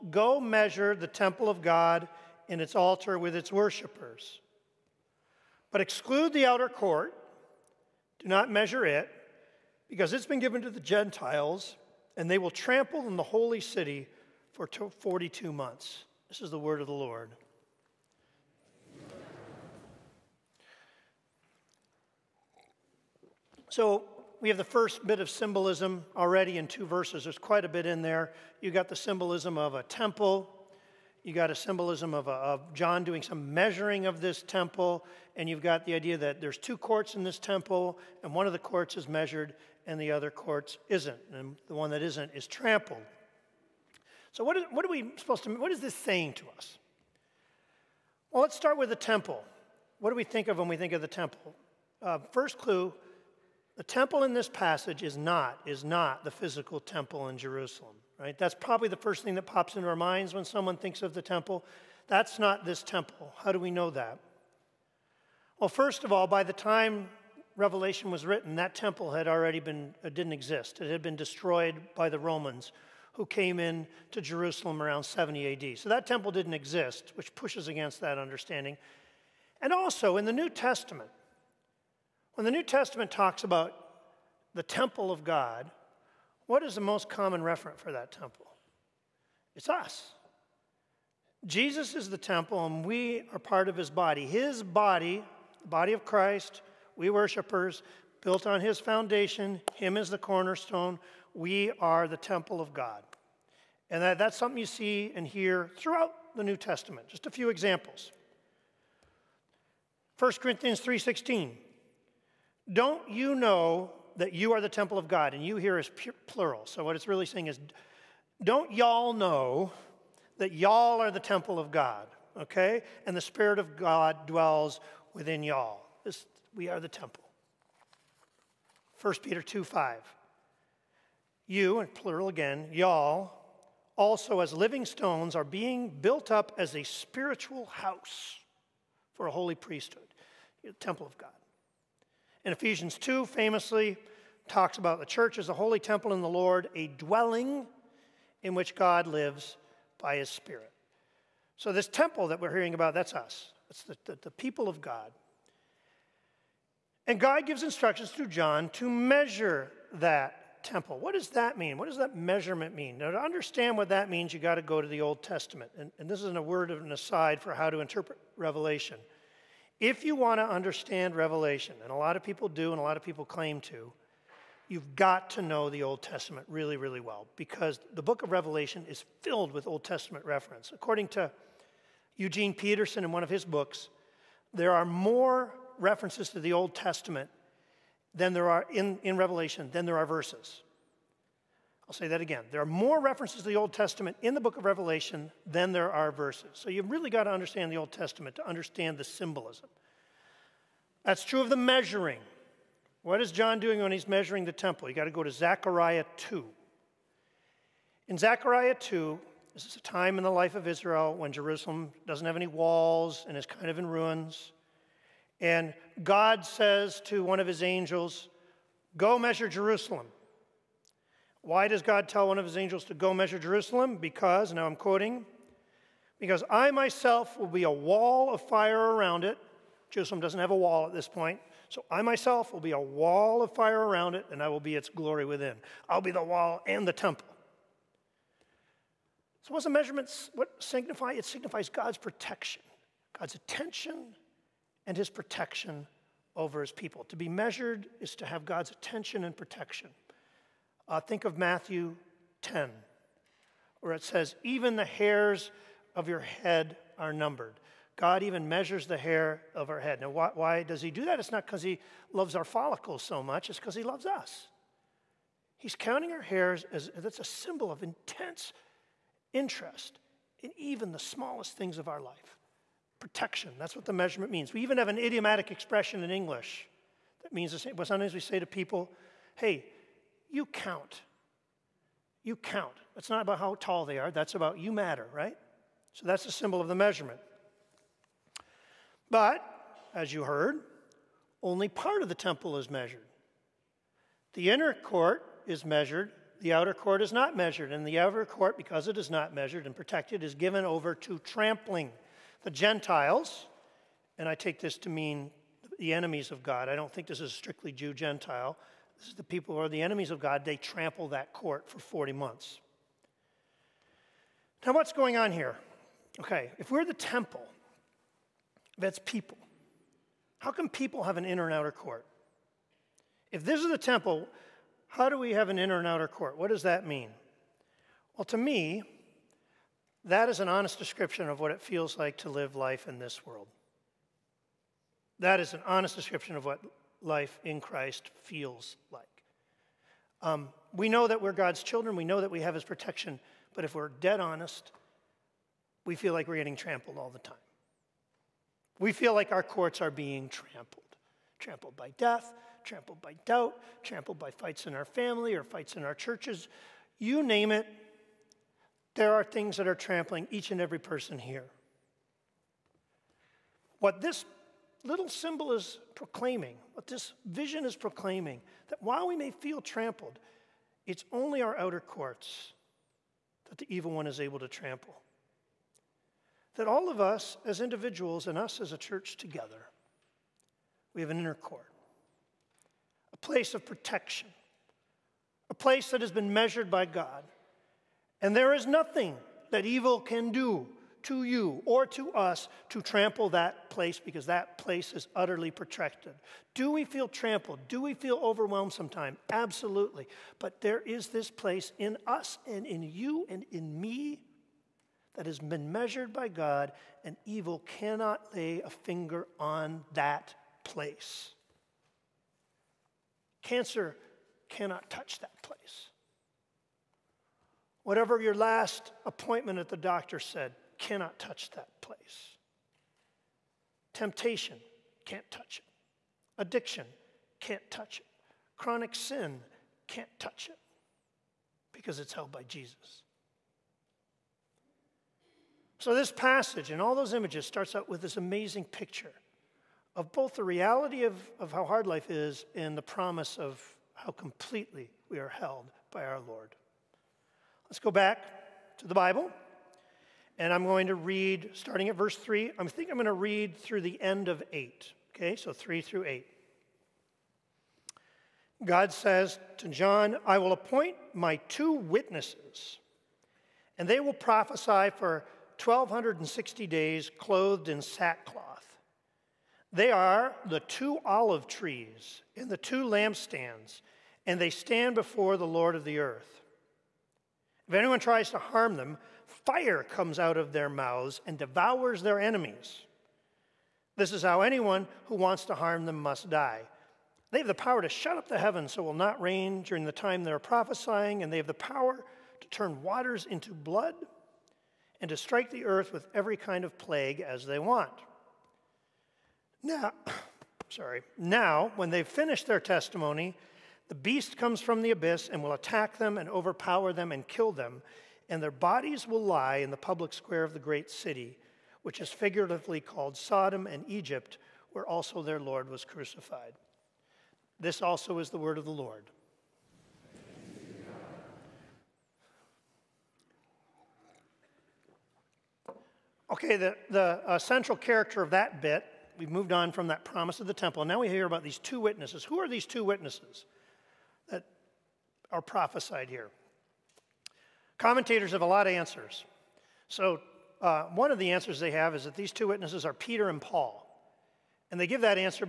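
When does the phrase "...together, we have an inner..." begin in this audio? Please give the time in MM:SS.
06:19.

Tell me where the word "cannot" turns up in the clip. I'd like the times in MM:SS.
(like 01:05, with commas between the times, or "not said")
06:47, 06:54, 07:00.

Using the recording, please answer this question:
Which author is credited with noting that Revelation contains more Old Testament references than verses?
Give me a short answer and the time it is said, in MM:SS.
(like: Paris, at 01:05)
Eugene Peterson, at 03:02.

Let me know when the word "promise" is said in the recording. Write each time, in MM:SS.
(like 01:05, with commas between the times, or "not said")
07:22, 08:50.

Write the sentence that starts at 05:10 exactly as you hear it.
They trample that court for 40 months.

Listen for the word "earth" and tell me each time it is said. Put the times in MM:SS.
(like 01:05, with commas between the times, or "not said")
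07:55, 08:15.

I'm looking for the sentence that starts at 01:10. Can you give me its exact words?
It had been destroyed by the Romans who came in to Jerusalem around 70 AD.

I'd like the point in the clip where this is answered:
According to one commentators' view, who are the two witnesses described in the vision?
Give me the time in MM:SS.
09:02.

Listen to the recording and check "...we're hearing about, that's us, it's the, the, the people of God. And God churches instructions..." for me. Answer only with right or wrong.
wrong.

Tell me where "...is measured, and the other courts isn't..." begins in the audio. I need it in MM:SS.
00:38.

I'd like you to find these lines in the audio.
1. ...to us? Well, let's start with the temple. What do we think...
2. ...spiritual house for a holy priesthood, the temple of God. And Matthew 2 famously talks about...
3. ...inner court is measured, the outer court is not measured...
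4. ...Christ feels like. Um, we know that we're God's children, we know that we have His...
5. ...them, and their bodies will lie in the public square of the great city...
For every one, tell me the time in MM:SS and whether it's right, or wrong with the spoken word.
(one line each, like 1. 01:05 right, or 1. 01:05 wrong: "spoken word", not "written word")
1. 00:46 right
2. 02:16 wrong: "Ephesians", not "Matthew"
3. 04:54 right
4. 05:37 right
5. 08:27 right.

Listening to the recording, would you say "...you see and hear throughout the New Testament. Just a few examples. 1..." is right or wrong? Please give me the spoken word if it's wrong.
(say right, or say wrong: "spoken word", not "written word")
right.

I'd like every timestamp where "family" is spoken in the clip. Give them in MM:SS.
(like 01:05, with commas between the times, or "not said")
05:54.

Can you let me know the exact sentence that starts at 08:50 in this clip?
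And now we hear about these two witnesses.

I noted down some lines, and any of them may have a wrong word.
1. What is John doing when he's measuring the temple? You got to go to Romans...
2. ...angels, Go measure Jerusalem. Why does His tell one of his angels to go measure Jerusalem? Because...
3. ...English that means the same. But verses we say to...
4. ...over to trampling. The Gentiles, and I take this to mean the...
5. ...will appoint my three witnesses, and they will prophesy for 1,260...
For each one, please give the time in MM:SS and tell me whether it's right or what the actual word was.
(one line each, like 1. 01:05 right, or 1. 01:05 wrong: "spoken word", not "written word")
1. 03:23 wrong: "Zechariah", not "Romans"
2. 03:37 wrong: "God", not "His"
3. 04:36 wrong: "sometimes", not "verses"
4. 05:00 right
5. 07:40 wrong: "two", not "three".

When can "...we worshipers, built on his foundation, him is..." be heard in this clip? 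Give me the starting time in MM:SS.
01:36.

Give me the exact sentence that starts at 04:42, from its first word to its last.
It's not about how tall they are, that's about you matter, right?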